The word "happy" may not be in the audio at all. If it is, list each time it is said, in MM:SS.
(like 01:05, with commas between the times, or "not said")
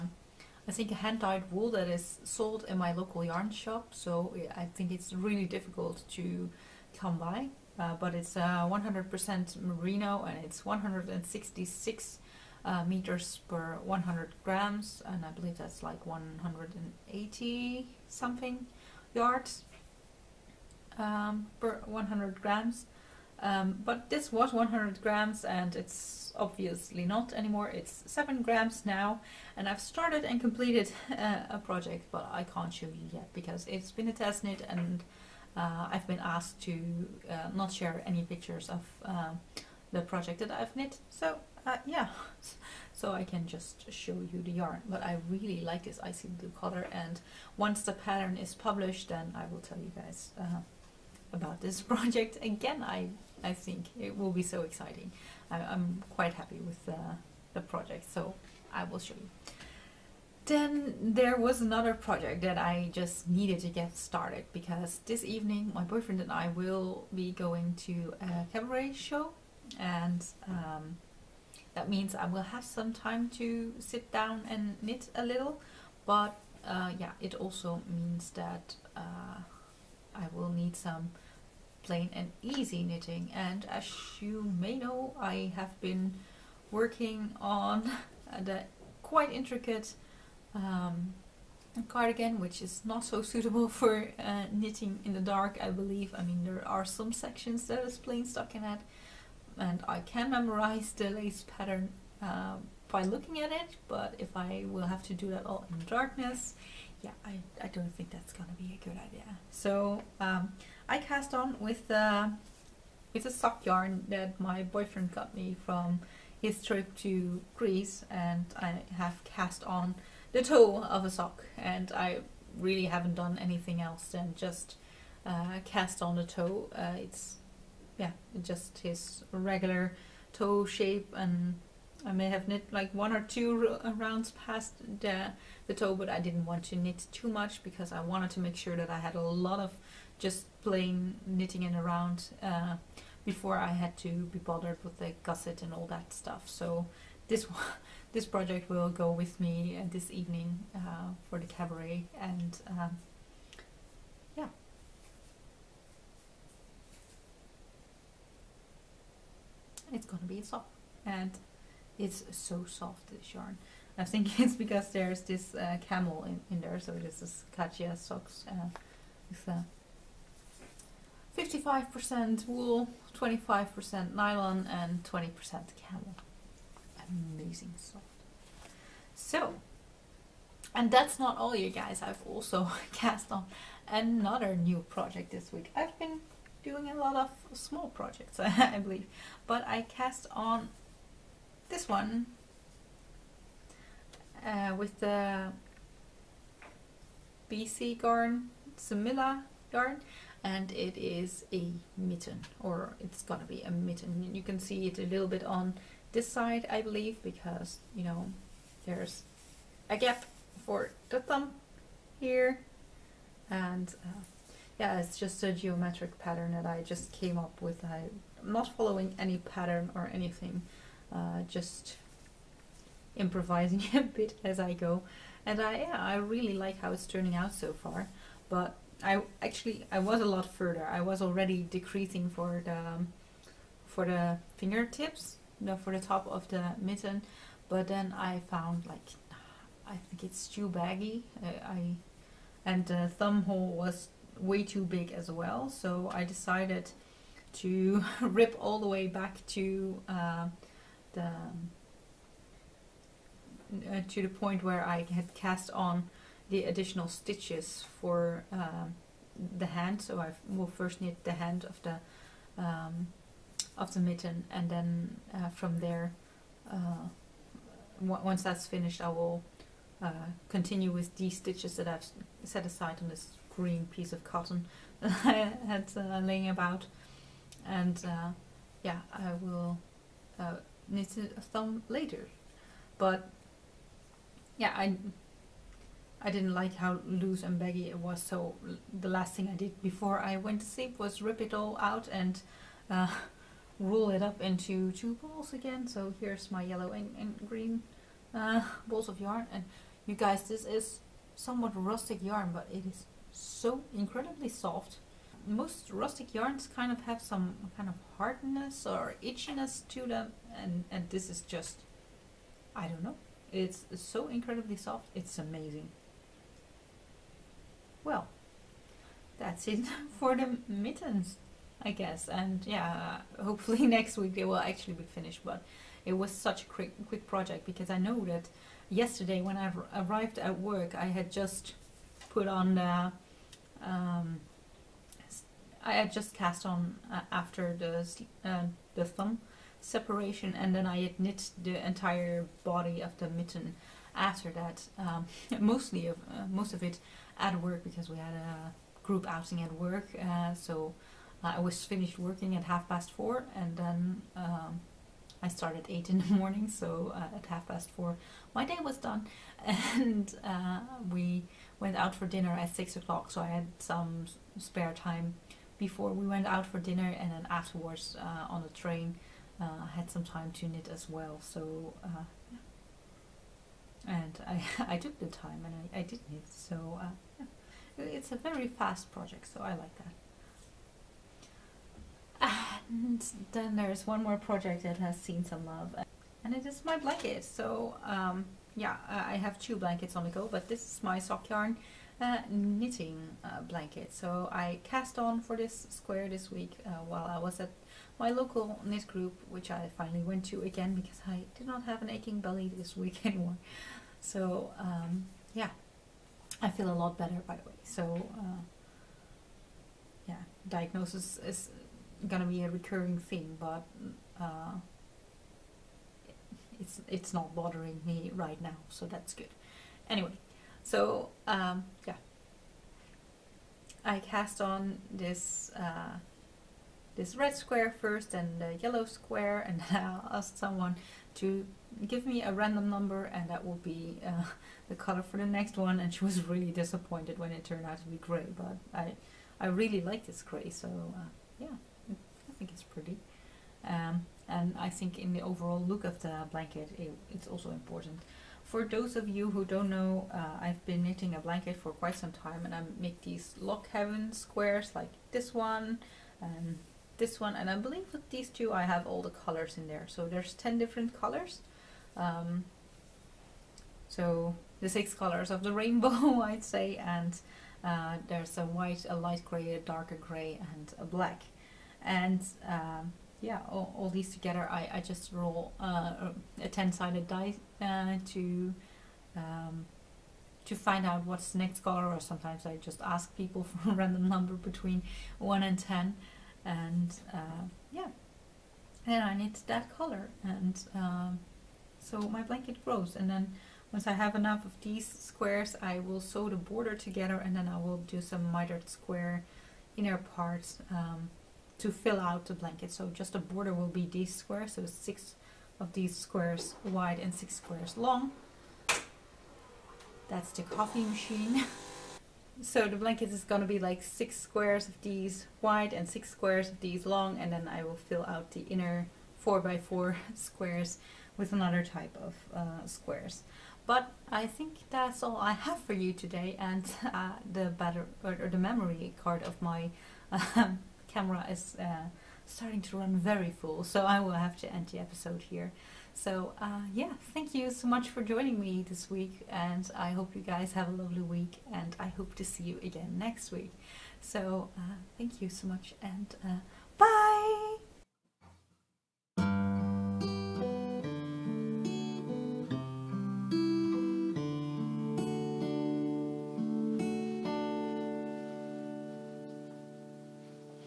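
00:56.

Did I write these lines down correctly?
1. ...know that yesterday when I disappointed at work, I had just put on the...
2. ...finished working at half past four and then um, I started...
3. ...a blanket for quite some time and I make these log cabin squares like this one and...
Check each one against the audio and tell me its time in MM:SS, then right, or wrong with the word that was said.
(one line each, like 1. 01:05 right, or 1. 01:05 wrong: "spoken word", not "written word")
1. 05:27 wrong: "arrived", not "disappointed"
2. 05:51 right
3. 07:31 right.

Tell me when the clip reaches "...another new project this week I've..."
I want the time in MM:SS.
03:03.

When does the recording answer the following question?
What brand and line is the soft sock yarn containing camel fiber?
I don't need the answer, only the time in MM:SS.
02:47.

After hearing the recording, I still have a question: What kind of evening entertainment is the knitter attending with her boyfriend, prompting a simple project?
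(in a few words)
Cabaret show.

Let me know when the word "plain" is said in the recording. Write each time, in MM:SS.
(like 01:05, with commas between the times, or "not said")
01:21, 01:37, 02:20.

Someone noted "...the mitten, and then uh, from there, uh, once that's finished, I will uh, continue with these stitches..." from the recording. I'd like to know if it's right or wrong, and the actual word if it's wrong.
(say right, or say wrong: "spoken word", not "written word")
right.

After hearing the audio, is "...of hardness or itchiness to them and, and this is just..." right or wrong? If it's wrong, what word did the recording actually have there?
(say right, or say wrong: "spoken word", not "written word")
right.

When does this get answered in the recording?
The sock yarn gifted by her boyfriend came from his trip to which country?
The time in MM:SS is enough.
01:57.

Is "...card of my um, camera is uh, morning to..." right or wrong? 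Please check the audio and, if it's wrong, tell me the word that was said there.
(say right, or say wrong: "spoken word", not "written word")
wrong: "starting", not "morning".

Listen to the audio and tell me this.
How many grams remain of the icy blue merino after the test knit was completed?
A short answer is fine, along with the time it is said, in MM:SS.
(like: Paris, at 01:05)
7 grams, at 00:28.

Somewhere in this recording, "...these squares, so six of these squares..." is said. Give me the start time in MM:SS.
08:24.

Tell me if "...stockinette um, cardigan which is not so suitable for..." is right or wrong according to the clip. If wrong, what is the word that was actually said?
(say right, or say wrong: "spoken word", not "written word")
wrong: "intricate", not "stockinette".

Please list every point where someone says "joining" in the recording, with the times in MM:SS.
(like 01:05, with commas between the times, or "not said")
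08:58.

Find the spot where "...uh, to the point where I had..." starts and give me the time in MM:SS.
04:13.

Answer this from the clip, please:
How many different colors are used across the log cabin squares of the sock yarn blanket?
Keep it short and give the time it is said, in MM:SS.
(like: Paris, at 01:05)
10, at 07:40.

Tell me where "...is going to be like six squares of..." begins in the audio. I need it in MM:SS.
08:33.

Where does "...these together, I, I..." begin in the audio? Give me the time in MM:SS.
07:54.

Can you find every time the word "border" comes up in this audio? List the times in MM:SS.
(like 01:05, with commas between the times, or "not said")
08:16, 08:23.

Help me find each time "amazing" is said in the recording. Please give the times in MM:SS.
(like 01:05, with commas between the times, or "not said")
02:57, 05:15.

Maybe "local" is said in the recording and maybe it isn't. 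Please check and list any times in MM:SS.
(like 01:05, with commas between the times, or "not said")
00:02, 06:38.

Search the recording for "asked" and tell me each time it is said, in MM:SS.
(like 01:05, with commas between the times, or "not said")
00:36, 07:10.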